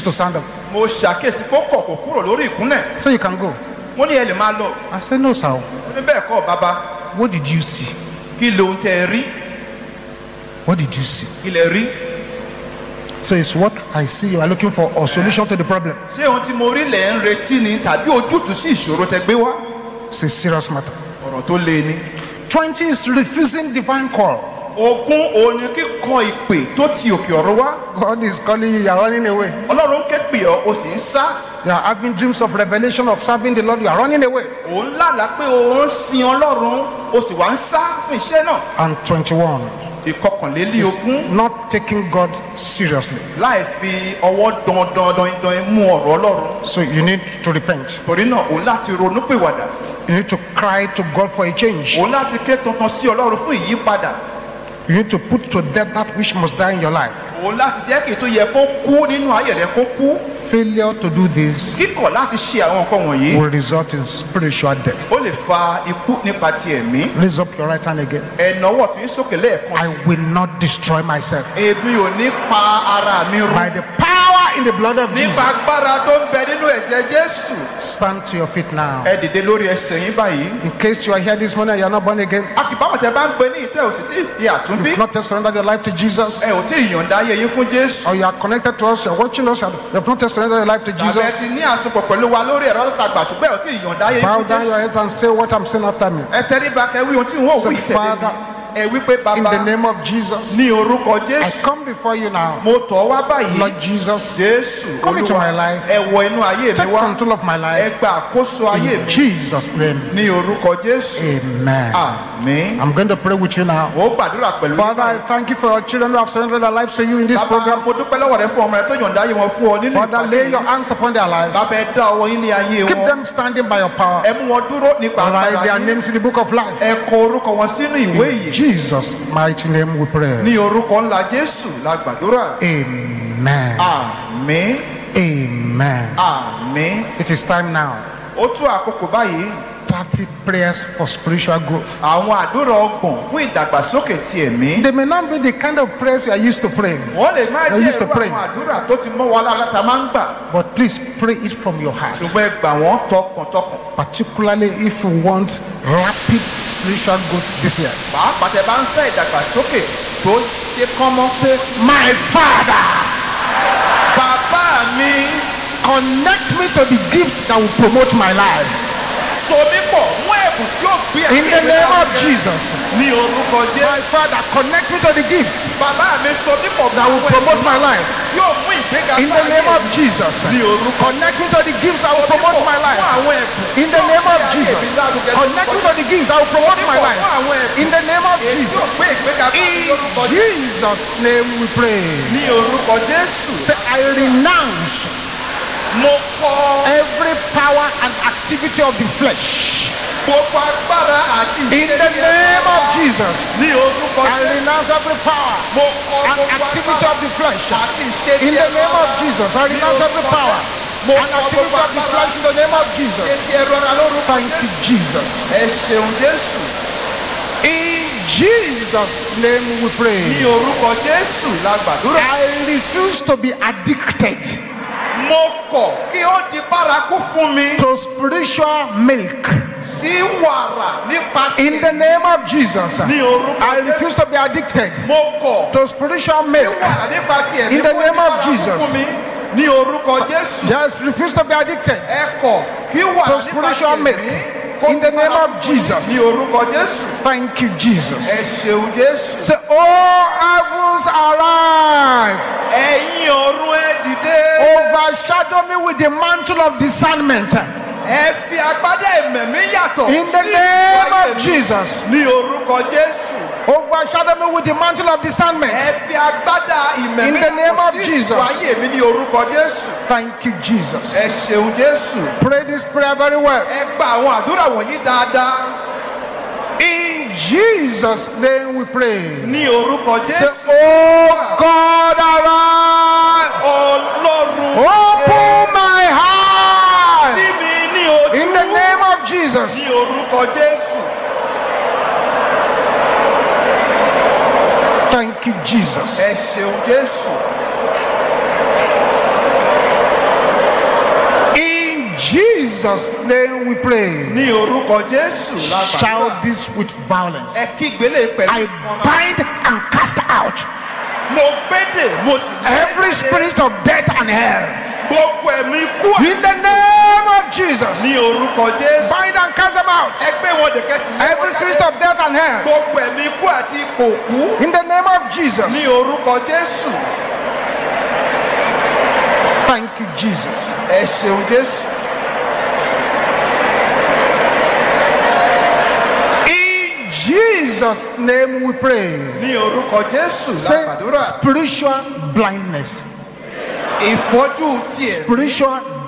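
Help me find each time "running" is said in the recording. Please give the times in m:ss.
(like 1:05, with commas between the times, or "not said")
0:29, 0:33.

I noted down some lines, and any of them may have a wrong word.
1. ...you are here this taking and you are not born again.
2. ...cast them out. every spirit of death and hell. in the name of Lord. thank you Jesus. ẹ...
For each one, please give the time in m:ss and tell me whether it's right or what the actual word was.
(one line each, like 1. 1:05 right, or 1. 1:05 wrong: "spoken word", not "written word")
1. 1:21 wrong: "morning", not "taking"
2. 5:19 wrong: "Jesus", not "Lord".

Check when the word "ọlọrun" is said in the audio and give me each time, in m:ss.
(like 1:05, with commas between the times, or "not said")
0:29, 0:36, 0:46, 4:43.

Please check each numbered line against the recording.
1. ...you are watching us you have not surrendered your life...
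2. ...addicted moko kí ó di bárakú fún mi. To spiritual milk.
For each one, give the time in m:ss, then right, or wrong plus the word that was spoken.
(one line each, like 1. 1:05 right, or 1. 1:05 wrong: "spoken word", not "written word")
1. 1:29 right
2. 3:43 right.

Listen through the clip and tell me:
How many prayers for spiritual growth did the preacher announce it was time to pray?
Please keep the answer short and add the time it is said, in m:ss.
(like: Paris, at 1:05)
30, at 2:19.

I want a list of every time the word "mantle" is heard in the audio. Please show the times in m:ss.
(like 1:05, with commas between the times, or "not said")
4:16, 4:24.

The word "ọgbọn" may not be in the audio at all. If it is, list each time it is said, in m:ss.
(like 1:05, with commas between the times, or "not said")
2:22.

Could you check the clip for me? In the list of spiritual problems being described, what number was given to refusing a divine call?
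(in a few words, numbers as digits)
20.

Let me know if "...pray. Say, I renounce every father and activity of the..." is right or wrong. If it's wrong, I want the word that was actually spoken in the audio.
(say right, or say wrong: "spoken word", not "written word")
wrong: "power", not "father".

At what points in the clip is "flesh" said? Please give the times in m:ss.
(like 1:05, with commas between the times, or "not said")
3:19, 3:27, 3:32.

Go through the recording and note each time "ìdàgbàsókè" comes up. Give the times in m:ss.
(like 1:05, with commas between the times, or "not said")
2:23, 2:39.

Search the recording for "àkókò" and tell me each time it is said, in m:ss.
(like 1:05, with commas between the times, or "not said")
2:18.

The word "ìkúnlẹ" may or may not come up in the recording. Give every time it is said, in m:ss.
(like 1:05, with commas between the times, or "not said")
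0:02.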